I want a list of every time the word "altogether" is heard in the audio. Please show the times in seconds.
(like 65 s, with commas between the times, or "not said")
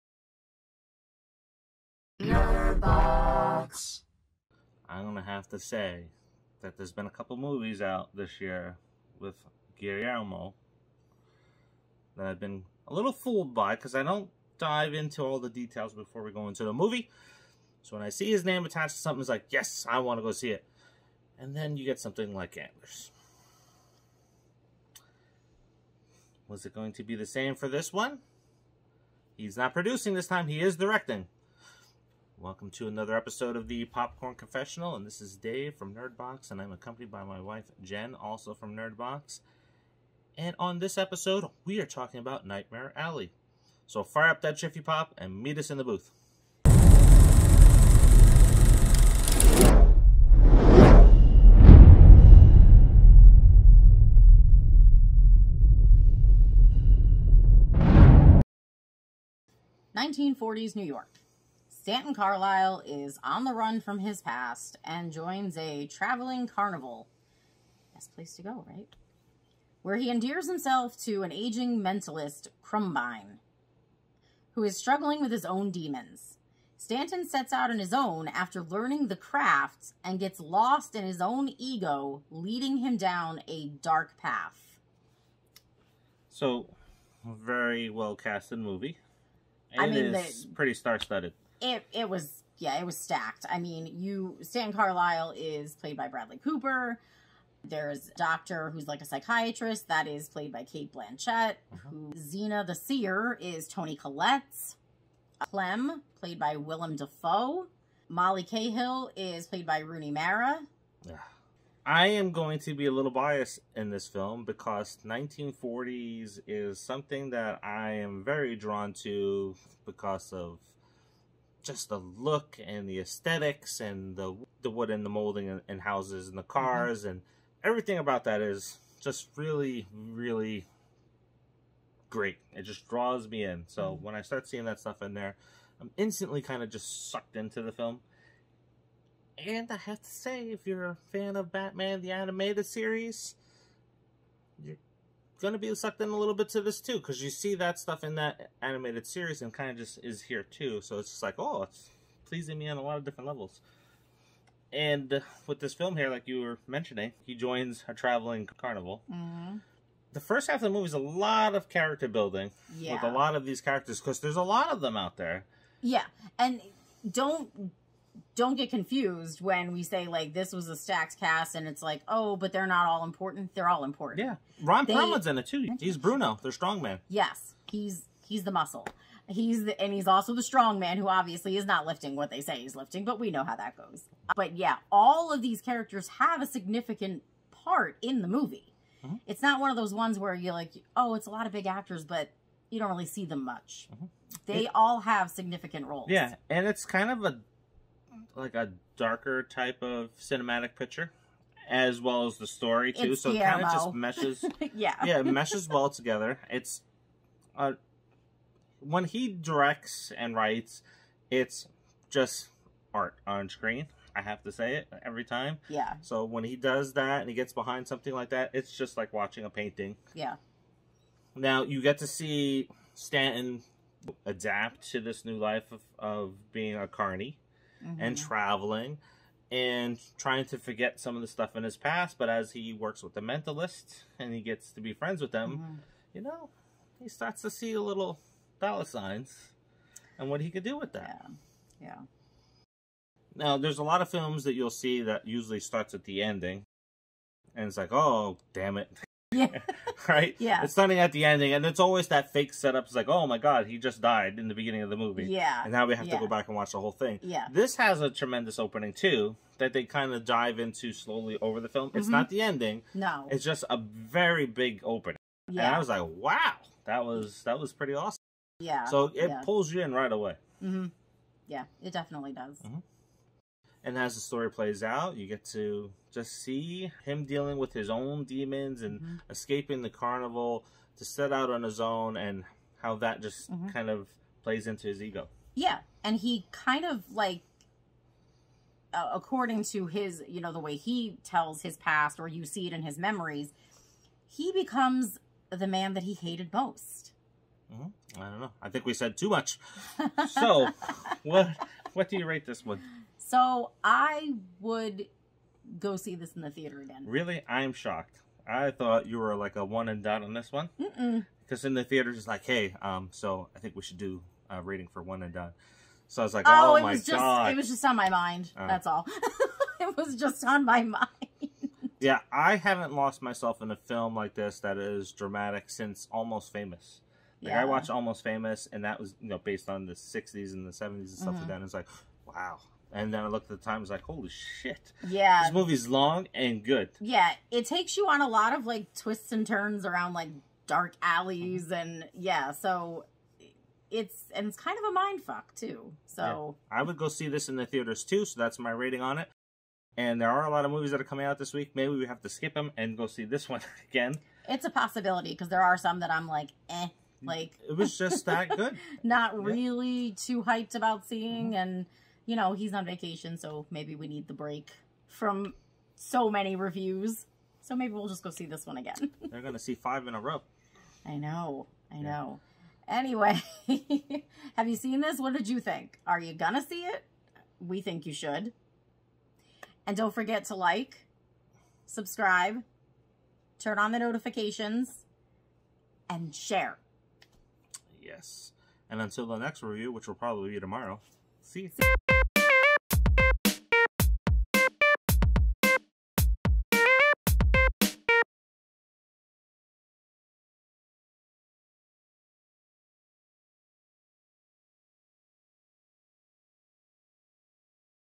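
not said.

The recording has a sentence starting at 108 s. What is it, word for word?
Molly Cahill is played by Rooney Mara.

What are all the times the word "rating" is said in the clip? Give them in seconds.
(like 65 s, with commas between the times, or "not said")
314 s, 348 s.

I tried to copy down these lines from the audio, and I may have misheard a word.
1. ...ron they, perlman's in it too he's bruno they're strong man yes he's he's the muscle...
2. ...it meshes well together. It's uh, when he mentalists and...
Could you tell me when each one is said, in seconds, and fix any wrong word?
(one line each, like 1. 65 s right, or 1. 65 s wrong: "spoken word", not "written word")
1. 174 s right
2. 205 s wrong: "directs", not "mentalists".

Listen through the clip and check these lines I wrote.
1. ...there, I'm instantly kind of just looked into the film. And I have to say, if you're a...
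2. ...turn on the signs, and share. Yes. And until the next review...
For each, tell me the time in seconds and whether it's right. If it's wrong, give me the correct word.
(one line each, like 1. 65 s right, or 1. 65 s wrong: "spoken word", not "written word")
1. 135 s wrong: "sucked", not "looked"
2. 383 s wrong: "notifications", not "signs".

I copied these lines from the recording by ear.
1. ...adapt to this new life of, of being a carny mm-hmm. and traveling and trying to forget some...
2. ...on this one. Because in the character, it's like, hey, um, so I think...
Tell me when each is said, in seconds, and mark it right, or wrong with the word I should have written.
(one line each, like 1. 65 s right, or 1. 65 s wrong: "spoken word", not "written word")
1. 224 s right
2. 310 s wrong: "theater", not "character".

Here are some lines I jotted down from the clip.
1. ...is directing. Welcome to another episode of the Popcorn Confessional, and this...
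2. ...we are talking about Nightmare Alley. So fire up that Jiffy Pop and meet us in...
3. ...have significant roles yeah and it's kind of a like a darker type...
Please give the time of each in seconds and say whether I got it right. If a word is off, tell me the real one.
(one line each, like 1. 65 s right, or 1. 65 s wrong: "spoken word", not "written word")
1. 30 s right
2. 41 s right
3. 195 s right.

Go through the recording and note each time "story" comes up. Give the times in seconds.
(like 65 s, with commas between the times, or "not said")
202 s, 274 s.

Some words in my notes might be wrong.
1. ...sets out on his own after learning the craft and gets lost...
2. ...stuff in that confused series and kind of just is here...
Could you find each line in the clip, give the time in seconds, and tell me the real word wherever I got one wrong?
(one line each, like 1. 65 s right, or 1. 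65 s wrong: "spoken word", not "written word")
1. 77 s right
2. 147 s wrong: "animated", not "confused".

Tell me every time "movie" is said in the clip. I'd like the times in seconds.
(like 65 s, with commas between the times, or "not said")
7 s, 16 s, 88 s, 160 s, 188 s, 254 s, 335 s, 350 s.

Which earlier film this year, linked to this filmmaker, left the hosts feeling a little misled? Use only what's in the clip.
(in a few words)
Antlers.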